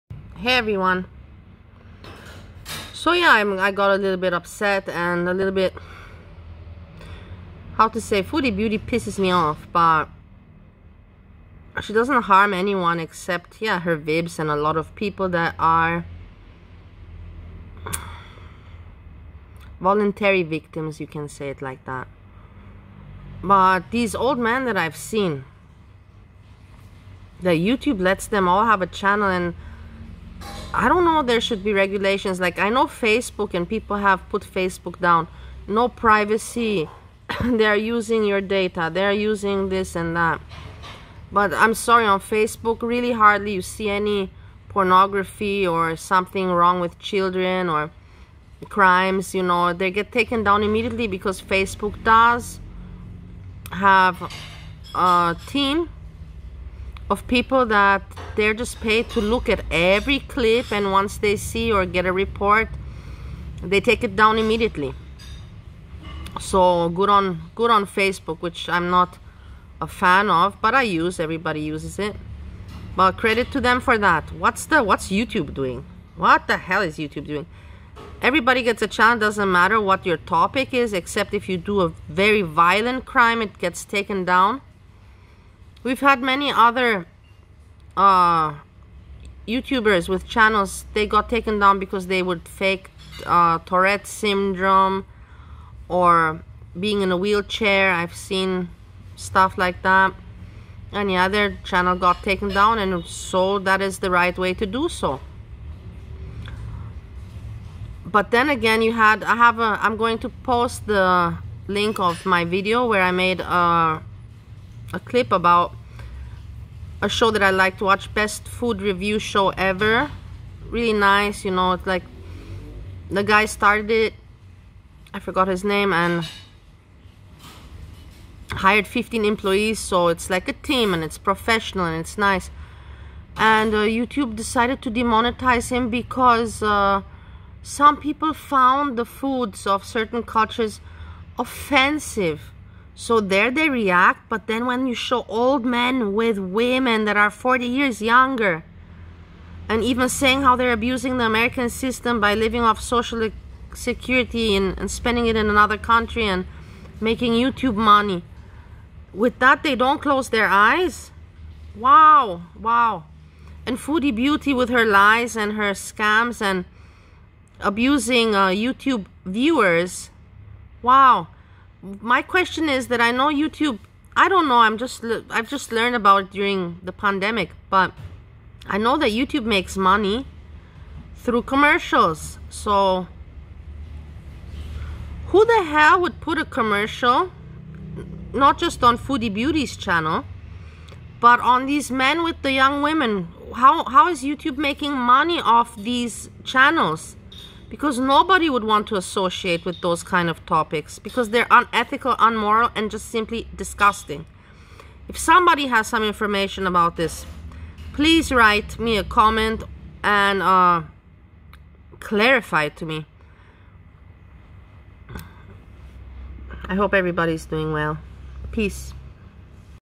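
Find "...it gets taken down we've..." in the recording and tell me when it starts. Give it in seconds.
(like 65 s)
83 s.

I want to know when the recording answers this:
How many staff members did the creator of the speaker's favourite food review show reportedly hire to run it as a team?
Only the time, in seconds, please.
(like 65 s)
128 s.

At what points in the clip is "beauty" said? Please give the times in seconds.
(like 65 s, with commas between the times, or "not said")
8 s, 164 s, 189 s.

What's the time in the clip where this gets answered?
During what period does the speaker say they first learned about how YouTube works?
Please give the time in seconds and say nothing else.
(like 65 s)
176 s.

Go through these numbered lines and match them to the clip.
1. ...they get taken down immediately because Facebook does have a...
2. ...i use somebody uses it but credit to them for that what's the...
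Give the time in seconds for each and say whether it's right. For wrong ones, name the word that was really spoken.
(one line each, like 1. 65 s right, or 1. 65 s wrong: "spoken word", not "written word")
1. 49 s right
2. 70 s wrong: "everybody", not "somebody".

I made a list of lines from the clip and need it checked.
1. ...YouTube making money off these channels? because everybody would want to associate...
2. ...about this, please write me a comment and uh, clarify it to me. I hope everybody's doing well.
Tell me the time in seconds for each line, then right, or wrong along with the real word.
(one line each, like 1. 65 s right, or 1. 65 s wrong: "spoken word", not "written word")
1. 194 s wrong: "nobody", not "everybody"
2. 206 s right.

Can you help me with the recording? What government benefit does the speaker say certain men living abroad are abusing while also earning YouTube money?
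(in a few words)
Social security.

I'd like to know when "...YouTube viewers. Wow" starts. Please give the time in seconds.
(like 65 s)
168 s.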